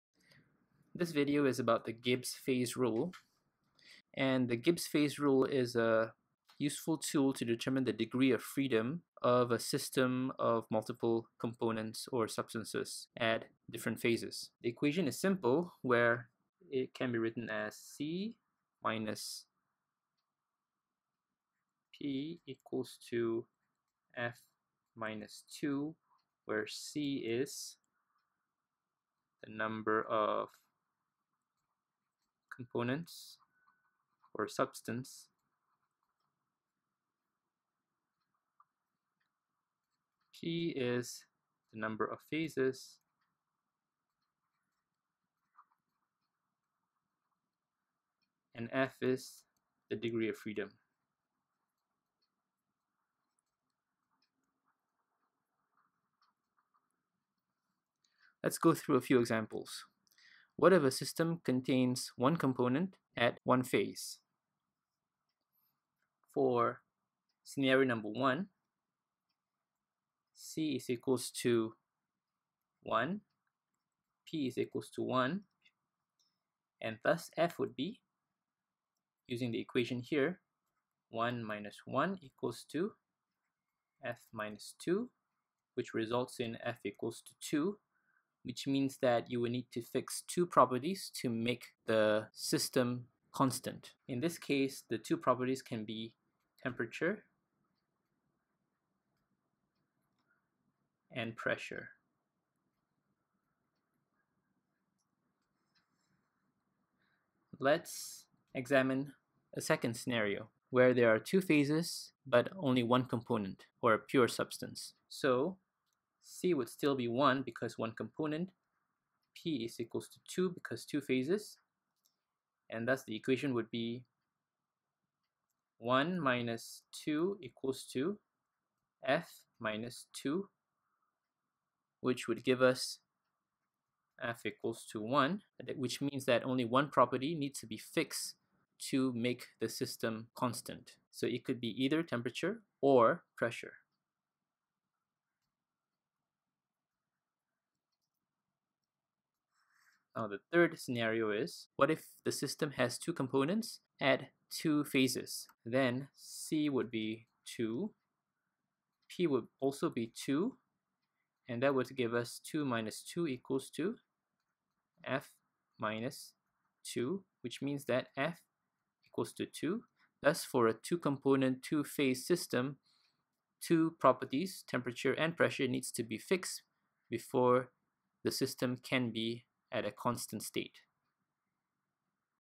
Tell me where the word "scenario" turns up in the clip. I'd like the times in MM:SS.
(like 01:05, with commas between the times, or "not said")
01:07, 01:49, 02:30.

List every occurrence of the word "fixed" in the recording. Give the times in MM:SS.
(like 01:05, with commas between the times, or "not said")
02:17, 02:56.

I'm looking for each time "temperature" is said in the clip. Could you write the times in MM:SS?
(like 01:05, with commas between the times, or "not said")
01:36, 02:22, 02:54.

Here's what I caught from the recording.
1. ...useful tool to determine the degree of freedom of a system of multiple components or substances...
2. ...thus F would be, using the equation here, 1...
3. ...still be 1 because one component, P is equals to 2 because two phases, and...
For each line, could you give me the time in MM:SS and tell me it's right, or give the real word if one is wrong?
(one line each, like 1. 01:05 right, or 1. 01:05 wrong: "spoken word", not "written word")
1. 00:06 right
2. 01:17 right
3. 01:56 right.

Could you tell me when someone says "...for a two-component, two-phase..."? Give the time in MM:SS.
02:50.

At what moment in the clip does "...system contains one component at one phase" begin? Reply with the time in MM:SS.
01:00.